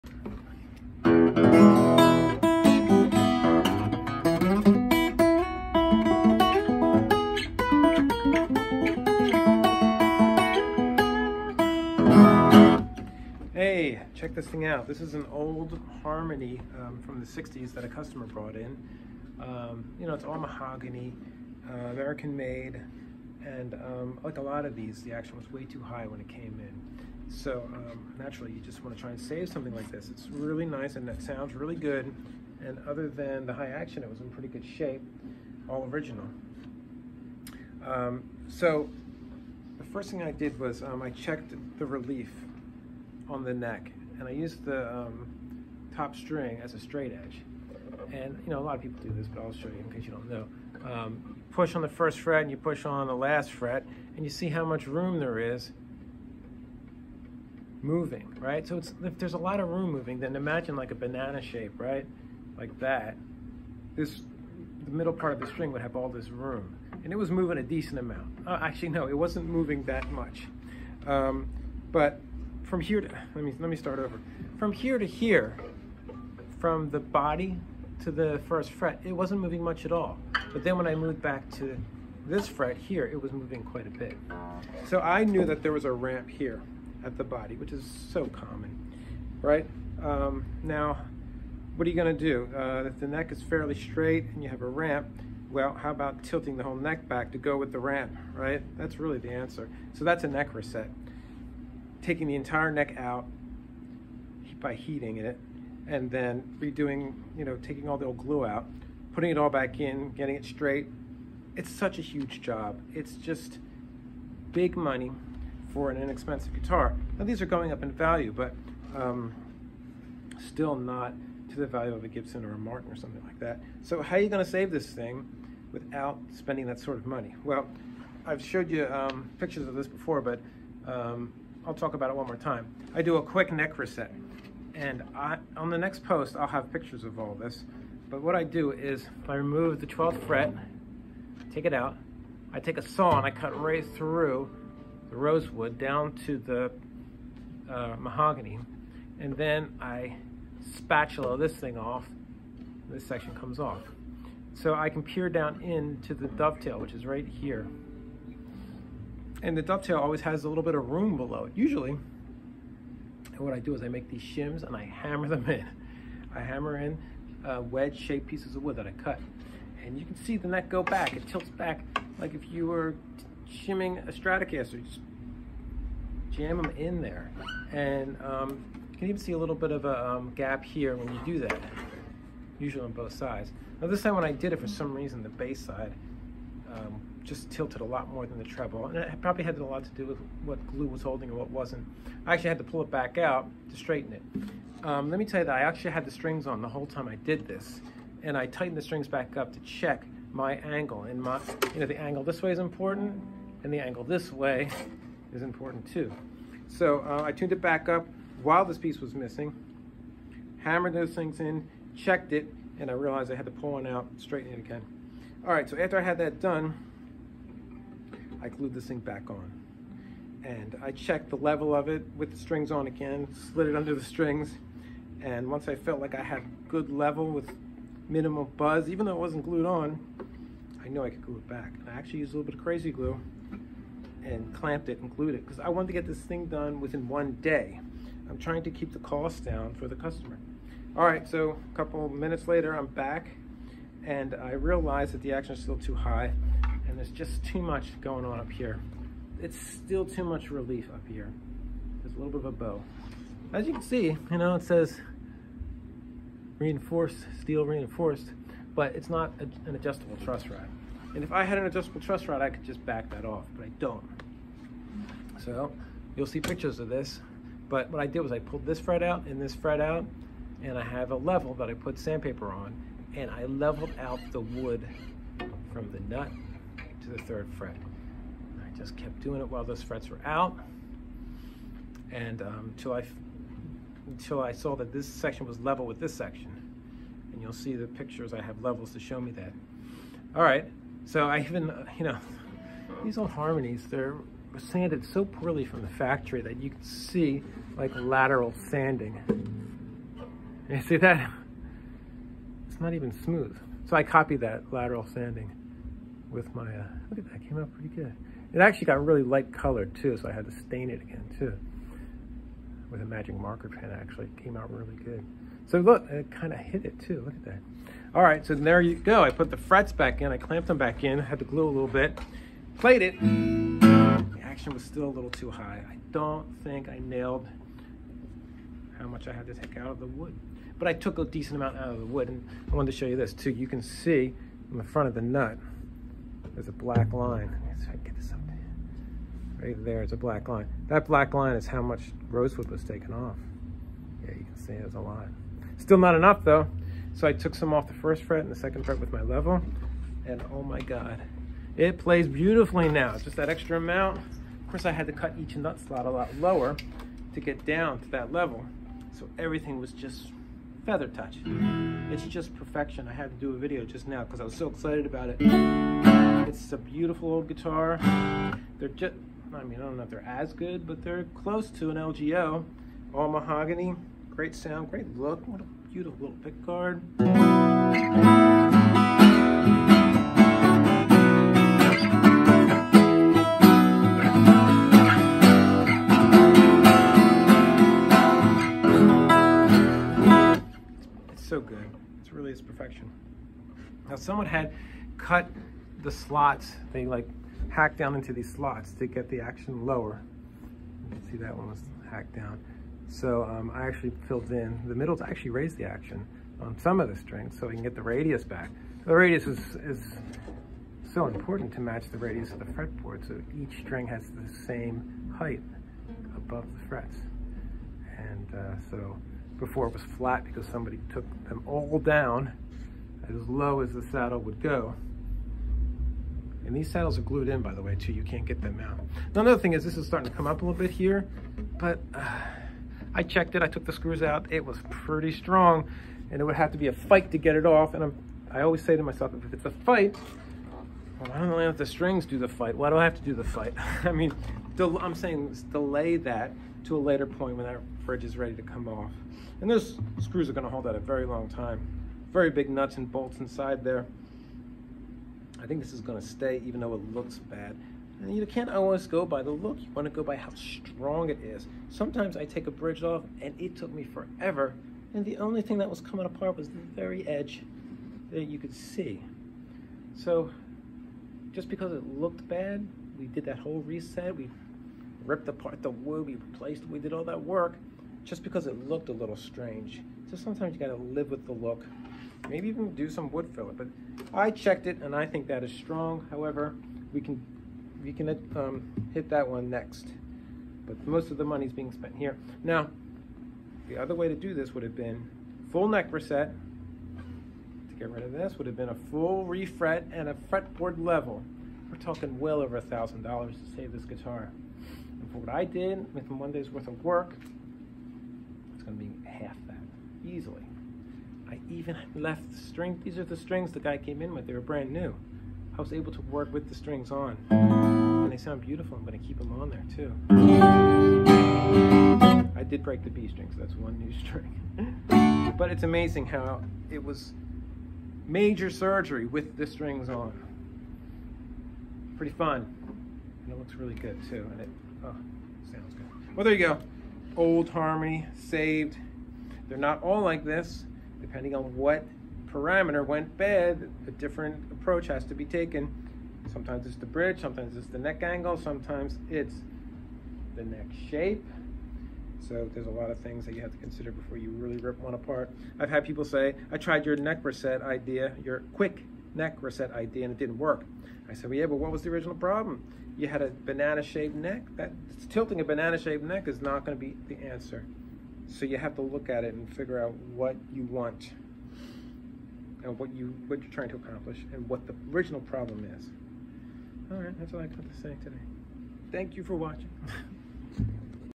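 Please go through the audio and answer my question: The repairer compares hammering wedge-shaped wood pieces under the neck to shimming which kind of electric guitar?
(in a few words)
Stratocaster.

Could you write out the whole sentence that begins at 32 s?
And other than the high action, it was in pretty good shape, all original.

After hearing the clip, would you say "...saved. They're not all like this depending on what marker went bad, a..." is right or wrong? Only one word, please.
wrong.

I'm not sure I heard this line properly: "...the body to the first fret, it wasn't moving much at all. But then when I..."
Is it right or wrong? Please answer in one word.
right.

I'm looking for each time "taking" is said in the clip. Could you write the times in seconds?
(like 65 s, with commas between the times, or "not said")
102 s, 107 s.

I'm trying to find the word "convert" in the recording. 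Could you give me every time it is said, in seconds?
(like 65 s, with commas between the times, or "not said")
not said.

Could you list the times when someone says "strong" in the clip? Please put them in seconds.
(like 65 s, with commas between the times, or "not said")
435 s, 460 s, 485 s.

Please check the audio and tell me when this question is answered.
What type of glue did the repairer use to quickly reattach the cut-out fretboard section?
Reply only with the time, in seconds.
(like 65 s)
232 s.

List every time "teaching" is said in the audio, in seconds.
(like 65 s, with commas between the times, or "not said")
not said.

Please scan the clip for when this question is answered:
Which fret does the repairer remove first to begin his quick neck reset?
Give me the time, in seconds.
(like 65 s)
139 s.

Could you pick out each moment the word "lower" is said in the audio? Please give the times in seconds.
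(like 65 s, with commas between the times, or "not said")
356 s, 399 s.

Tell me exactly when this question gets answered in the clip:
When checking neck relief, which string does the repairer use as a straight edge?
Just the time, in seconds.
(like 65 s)
45 s.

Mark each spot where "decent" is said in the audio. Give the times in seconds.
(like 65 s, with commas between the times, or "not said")
67 s, 331 s.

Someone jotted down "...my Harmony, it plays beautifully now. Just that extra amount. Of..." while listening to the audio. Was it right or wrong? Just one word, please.
wrong.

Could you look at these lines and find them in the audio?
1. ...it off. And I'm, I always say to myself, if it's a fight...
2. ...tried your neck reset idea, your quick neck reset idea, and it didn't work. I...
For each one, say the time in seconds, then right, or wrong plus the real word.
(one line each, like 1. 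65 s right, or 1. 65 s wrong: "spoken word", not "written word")
1. 437 s right
2. 556 s right.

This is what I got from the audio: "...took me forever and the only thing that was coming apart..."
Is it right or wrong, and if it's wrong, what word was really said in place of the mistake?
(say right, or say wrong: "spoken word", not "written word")
right.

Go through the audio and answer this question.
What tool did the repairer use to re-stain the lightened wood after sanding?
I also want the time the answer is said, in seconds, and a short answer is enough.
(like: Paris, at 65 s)
magic marker pen, at 313 s.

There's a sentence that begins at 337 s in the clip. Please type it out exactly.
Let's try to get this up there.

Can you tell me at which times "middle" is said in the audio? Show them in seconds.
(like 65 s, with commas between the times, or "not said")
64 s, 404 s.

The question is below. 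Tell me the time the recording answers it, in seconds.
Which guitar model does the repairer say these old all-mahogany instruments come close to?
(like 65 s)
371 s.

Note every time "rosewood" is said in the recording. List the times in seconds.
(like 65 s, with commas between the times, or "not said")
145 s, 342 s.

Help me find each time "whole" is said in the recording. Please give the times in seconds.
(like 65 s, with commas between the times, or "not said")
96 s, 196 s, 473 s.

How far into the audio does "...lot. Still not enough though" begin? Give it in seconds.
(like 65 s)
344 s.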